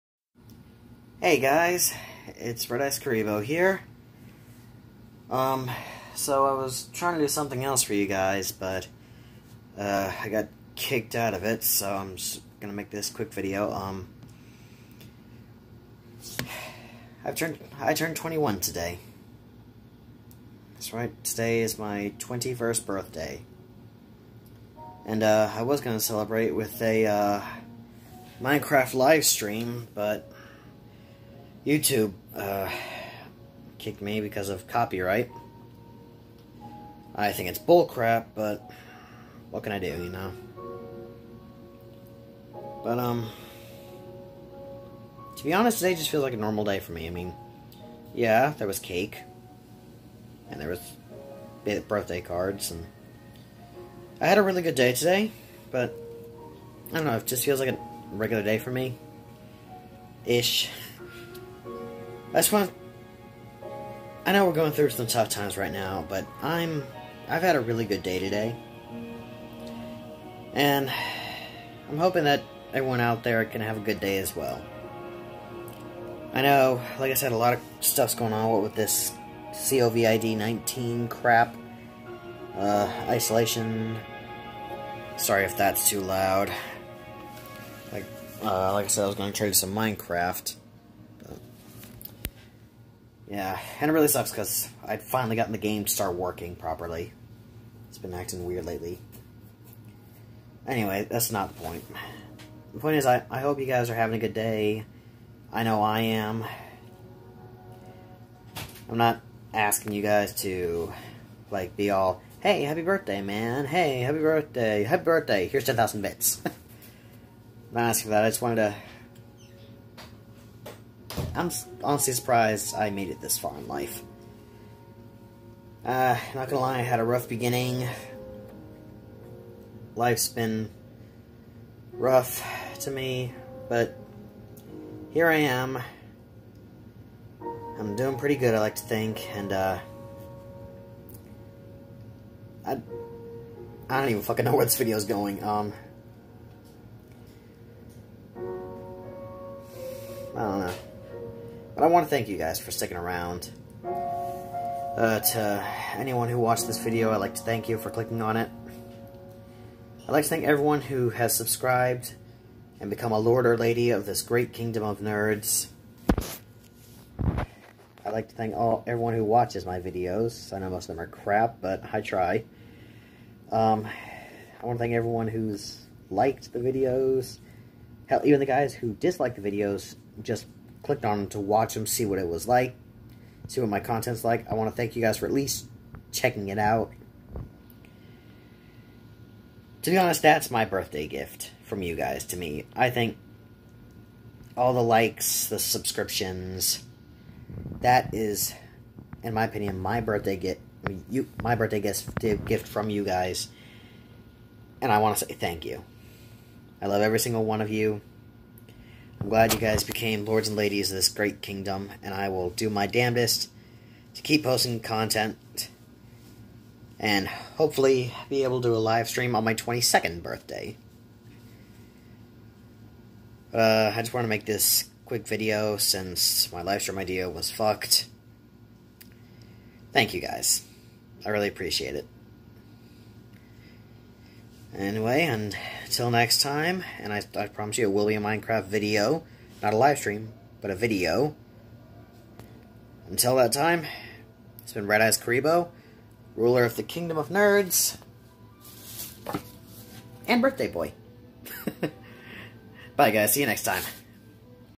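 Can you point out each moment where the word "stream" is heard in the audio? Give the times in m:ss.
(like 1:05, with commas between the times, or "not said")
0:29, 3:39, 3:46, 3:59.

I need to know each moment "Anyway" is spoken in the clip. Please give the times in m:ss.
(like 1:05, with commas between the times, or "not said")
1:40, 3:54.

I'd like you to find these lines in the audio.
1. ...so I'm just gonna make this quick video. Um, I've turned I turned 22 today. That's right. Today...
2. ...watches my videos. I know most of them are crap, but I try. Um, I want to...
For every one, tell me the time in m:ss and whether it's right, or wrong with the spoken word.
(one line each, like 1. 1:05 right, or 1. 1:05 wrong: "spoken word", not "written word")
1. 0:11 wrong: "21", not "22"
2. 2:49 right.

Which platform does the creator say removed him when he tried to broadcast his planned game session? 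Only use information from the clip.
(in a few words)
YouTube.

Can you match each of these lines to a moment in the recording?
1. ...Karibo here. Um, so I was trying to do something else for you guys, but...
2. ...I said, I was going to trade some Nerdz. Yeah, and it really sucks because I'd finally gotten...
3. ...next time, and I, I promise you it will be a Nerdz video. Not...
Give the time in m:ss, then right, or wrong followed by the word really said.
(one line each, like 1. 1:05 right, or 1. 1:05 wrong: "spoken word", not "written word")
1. 0:02 right
2. 1:28 wrong: "Minecraft", not "Nerdz"
3. 3:56 wrong: "Minecraft", not "Nerdz".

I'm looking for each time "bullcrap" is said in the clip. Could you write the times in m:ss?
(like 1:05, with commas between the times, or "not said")
0:37.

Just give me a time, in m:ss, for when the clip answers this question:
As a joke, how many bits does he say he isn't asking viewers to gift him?
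1:55.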